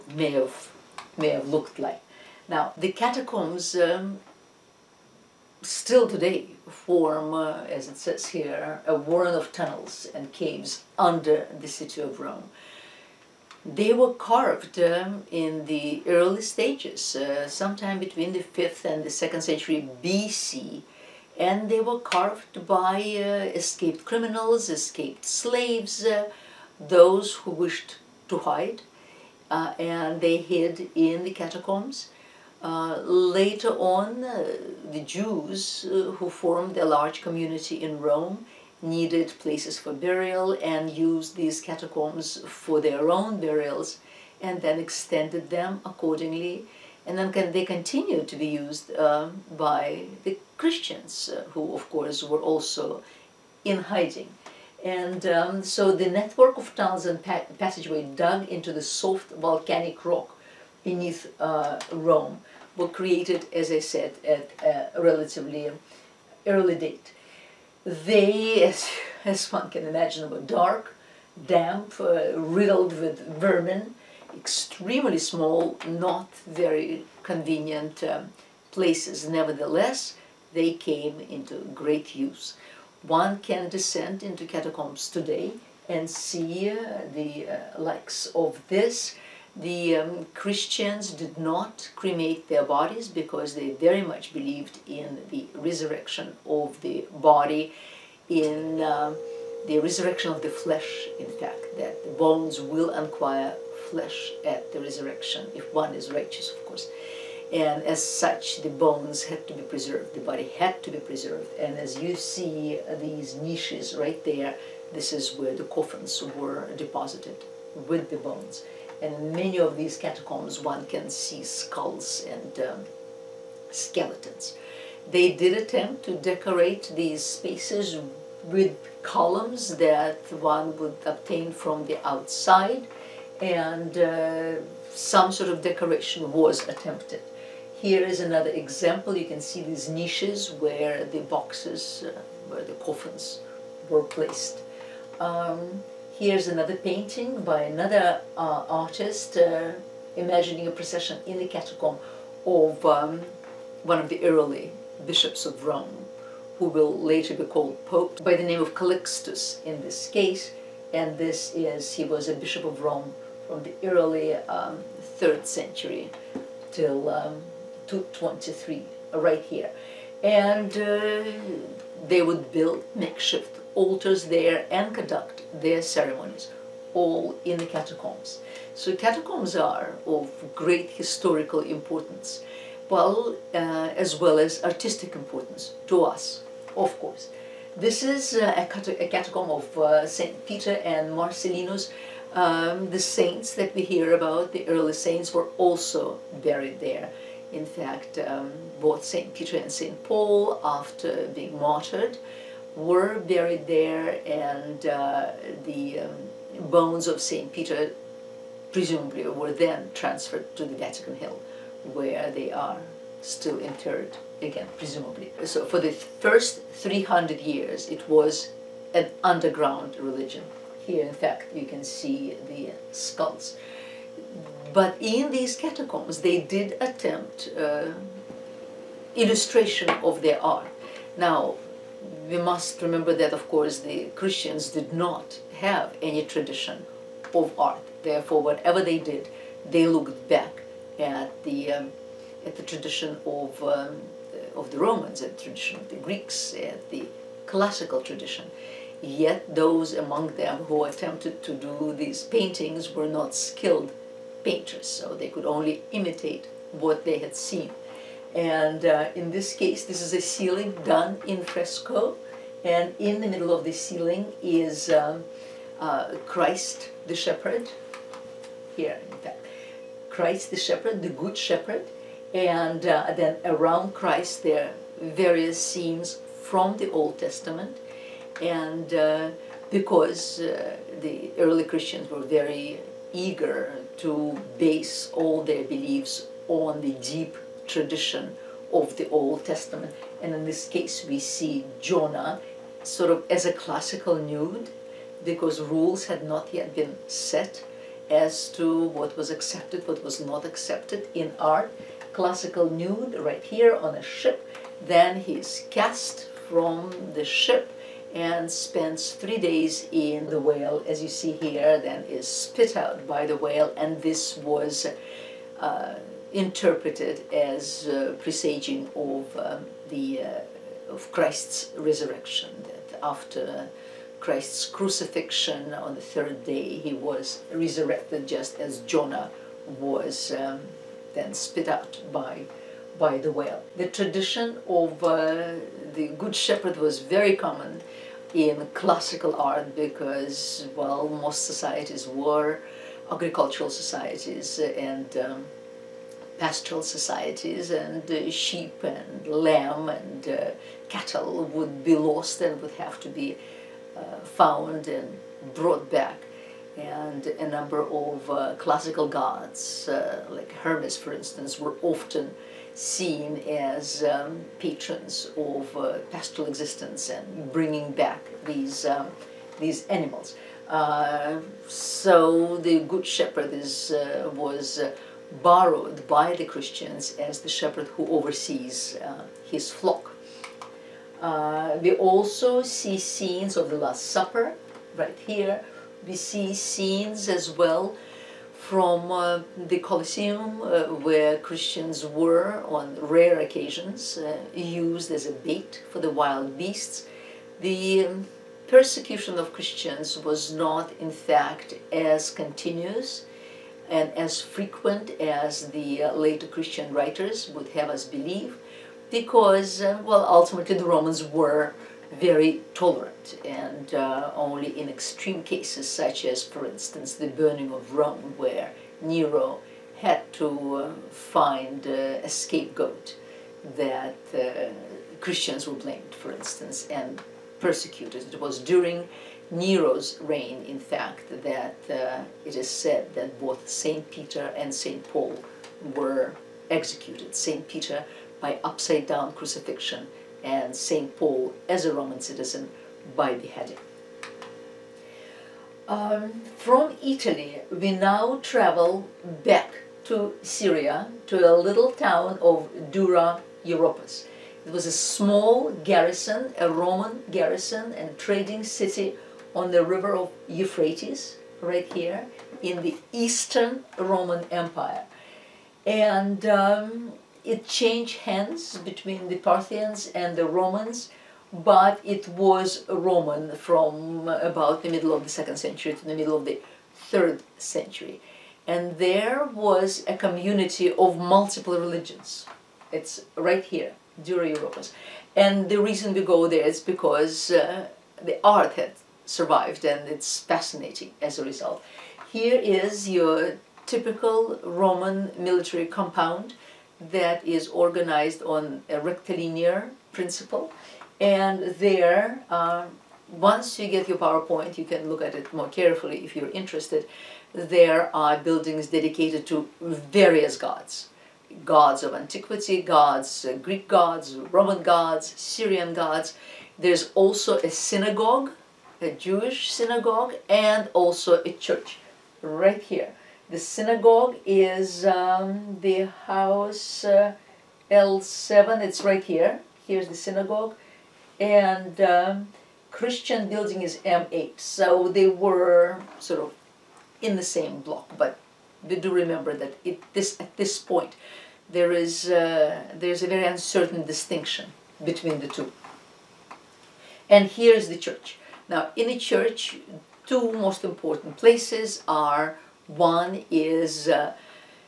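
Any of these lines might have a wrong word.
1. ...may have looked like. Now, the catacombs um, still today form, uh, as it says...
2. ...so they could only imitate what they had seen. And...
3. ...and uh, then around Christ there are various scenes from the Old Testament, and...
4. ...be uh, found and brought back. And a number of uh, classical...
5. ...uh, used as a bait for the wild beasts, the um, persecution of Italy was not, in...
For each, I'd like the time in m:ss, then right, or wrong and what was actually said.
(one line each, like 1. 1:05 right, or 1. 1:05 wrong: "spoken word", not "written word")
1. 0:01 right
2. 4:14 right
3. 4:32 right
4. 5:53 right
5. 6:34 wrong: "Christians", not "Italy".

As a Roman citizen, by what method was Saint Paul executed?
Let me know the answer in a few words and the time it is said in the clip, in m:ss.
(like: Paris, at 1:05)
Beheading, at 7:23.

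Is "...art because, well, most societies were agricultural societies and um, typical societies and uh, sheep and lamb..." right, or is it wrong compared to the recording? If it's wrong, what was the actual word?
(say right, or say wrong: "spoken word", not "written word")
wrong: "pastoral", not "typical".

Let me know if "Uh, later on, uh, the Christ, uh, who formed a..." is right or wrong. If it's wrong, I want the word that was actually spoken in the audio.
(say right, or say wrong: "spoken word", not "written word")
wrong: "Jews", not "Christ".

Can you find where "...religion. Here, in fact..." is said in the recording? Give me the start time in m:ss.
3:39.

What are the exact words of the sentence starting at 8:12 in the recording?
Here is your typical Roman military compound that is organized on a rectilinear principle.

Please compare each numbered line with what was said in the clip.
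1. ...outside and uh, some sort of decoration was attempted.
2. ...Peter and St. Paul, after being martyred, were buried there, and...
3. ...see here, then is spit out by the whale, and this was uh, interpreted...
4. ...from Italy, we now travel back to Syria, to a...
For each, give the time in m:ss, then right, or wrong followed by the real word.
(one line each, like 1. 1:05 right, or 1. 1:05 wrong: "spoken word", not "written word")
1. 2:12 right
2. 3:19 right
3. 5:11 right
4. 7:26 right.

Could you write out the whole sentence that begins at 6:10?
Uh, so the Good Shepherd is, uh, was uh, borrowed by the Christians as the shepherd who oversees uh, his flock.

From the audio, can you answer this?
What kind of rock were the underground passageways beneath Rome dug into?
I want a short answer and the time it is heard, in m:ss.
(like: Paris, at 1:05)
Soft volcanic rock, at 0:58.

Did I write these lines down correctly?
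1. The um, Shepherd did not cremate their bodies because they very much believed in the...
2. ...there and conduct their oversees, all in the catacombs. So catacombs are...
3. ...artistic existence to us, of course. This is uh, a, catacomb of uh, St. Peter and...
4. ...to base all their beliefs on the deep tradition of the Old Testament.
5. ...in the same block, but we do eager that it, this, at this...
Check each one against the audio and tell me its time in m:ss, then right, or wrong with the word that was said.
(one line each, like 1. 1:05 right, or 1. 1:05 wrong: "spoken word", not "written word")
1. 1:29 wrong: "Christians", not "Shepherd"
2. 2:54 wrong: "ceremonies", not "oversees"
3. 3:04 wrong: "importance", not "existence"
4. 4:43 right
5. 8:57 wrong: "remember", not "eager".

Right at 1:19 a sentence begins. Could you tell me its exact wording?
Nevertheless, they came into great use.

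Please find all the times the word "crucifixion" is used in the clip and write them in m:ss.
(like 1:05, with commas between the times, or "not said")
5:24, 7:19.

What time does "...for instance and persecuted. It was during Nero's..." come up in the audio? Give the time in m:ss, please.
7:06.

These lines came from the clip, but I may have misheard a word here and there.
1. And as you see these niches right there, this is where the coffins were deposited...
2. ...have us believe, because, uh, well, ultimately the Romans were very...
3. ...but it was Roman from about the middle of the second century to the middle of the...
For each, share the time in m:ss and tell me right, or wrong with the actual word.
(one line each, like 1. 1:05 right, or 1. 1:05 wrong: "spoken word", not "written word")
1. 1:51 right
2. 6:47 right
3. 7:51 right.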